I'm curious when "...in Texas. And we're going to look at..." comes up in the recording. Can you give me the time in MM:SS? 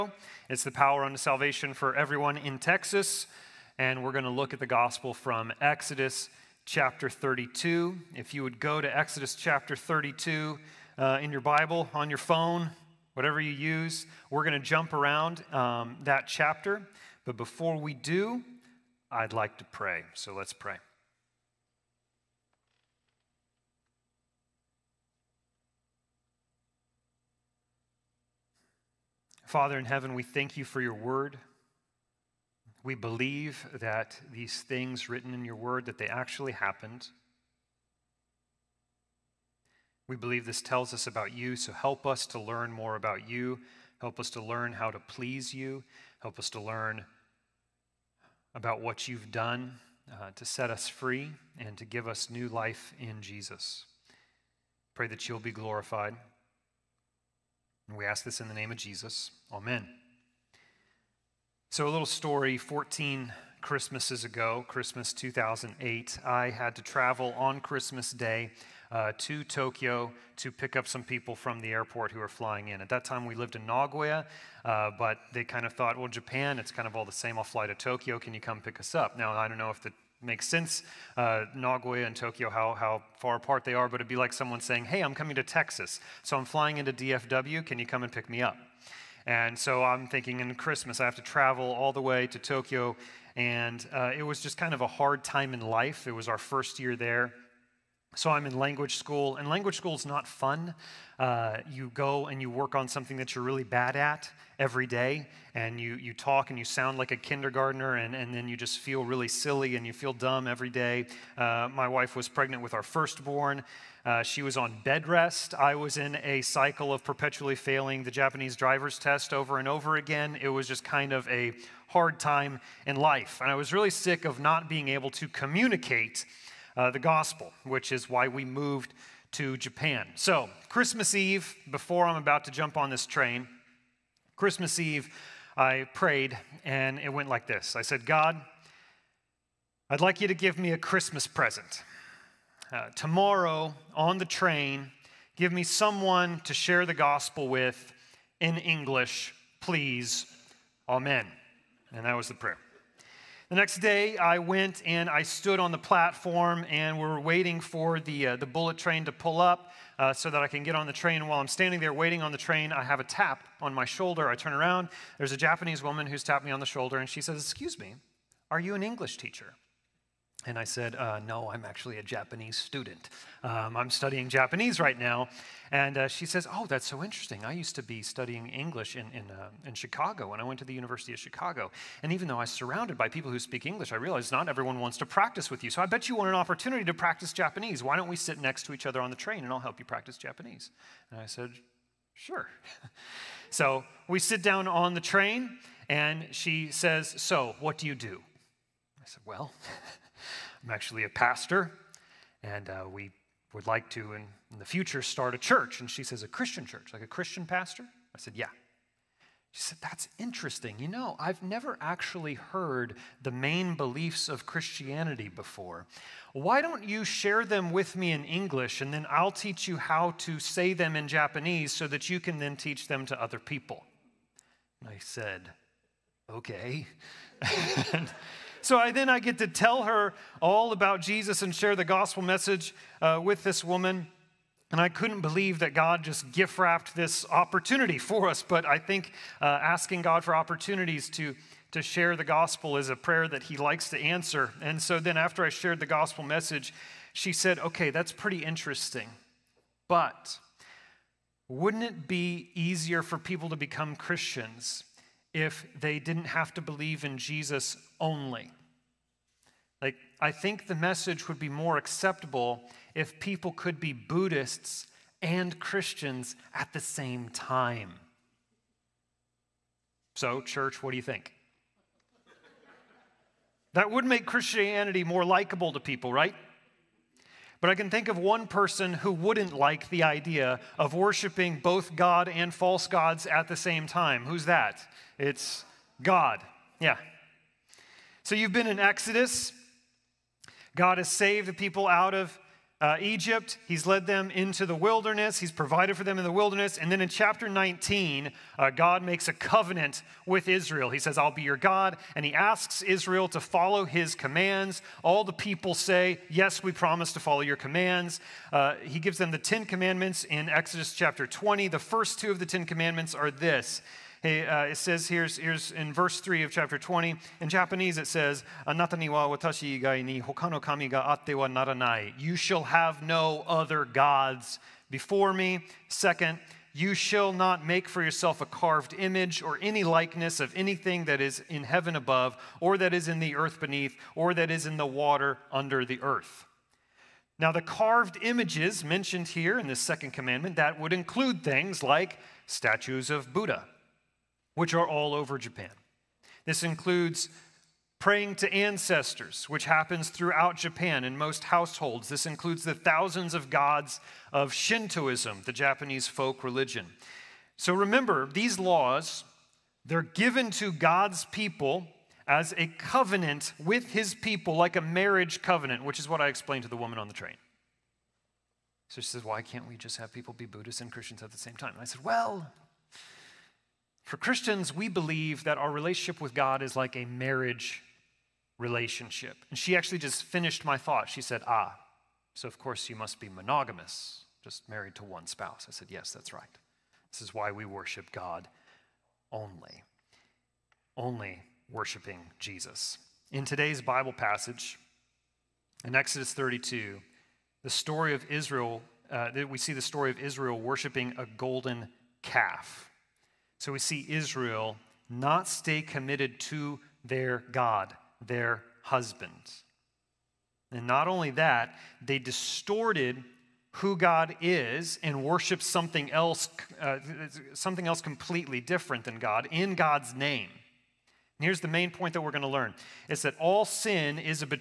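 00:02.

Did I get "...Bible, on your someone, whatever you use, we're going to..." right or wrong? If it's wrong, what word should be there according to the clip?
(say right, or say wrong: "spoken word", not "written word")
wrong: "phone", not "someone".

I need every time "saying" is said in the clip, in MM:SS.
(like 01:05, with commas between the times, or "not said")
01:24.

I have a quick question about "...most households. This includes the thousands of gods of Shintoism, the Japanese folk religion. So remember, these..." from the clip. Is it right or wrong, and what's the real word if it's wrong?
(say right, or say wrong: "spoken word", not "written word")
right.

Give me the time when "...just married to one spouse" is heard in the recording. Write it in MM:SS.
06:24.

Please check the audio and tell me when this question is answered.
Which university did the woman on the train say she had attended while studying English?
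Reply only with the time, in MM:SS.
03:00.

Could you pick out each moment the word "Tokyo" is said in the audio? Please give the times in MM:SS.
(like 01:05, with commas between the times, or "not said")
01:09, 01:17, 01:22, 01:32.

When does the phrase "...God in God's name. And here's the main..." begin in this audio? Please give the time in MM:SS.
06:59.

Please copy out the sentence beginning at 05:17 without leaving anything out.
In Japanese, it says, Anata ni wa watashi igai ni hoka no kami ga atte wa naranai.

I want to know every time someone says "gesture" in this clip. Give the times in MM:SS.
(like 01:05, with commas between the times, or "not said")
not said.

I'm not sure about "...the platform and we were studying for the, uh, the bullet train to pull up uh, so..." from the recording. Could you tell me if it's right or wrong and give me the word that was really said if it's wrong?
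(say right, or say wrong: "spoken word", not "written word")
wrong: "waiting", not "studying".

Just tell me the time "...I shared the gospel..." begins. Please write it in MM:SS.
04:05.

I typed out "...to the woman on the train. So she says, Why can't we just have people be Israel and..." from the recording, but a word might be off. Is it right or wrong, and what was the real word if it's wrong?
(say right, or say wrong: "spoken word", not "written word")
wrong: "Buddhists", not "Israel".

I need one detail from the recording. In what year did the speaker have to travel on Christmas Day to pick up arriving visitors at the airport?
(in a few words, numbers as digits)
2008.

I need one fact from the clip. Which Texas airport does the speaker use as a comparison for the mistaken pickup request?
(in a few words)
DFW.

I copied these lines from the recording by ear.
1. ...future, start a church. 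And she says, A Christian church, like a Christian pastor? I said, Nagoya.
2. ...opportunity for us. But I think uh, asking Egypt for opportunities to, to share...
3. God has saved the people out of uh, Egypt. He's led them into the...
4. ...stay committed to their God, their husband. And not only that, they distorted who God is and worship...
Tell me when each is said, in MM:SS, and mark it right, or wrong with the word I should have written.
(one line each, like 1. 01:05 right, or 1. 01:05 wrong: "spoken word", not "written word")
1. 03:24 wrong: "Yeah", not "Nagoya"
2. 03:57 wrong: "God", not "Egypt"
3. 04:50 right
4. 06:45 right.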